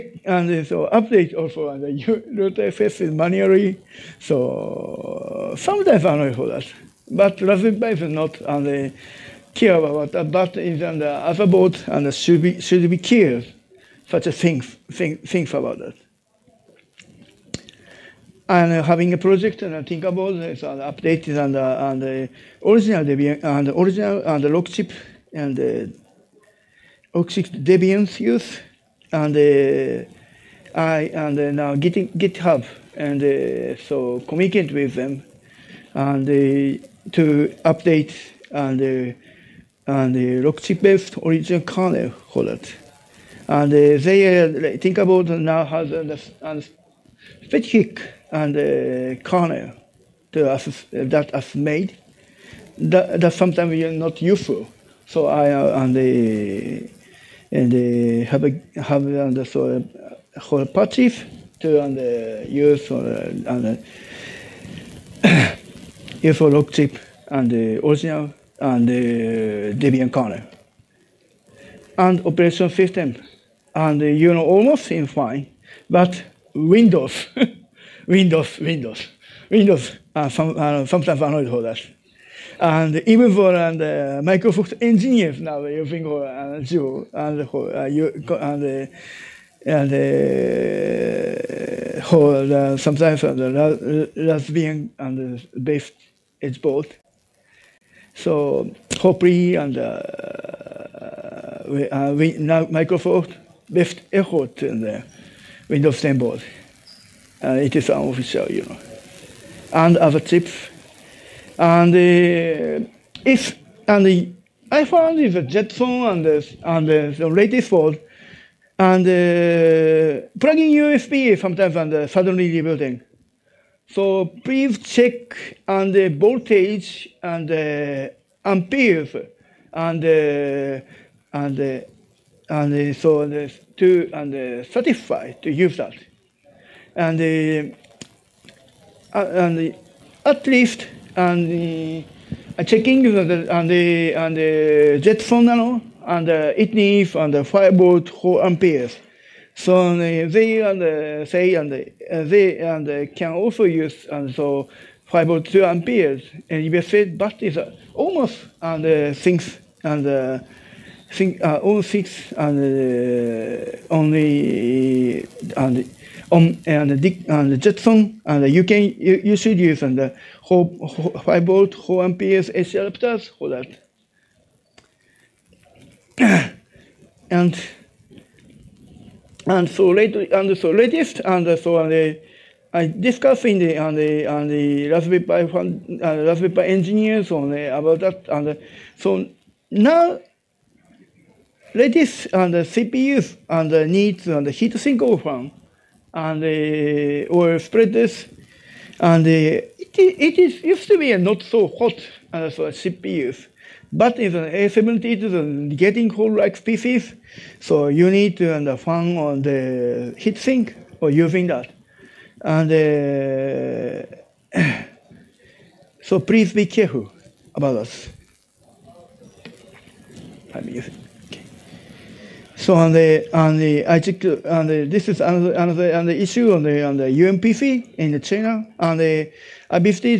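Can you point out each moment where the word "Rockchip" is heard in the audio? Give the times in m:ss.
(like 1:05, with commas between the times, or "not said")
0:24, 0:40, 1:06.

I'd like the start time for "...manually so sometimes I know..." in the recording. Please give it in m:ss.
0:02.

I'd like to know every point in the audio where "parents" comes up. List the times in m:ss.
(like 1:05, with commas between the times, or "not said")
not said.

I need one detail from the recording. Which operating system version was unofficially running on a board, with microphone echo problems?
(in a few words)
Windows 10.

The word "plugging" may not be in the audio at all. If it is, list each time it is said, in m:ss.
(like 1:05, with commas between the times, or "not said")
2:00.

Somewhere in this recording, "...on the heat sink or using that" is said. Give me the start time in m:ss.
3:29.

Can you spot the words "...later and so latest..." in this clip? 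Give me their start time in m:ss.
2:59.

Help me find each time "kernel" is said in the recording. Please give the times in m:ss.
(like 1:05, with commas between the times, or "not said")
0:41, 0:49, 1:10.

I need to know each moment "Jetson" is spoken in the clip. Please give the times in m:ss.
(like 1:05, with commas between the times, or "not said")
1:55, 2:25, 2:47.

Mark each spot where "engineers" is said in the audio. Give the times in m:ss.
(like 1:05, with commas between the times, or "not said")
1:24, 3:06.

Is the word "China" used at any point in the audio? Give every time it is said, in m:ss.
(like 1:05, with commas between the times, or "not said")
3:48.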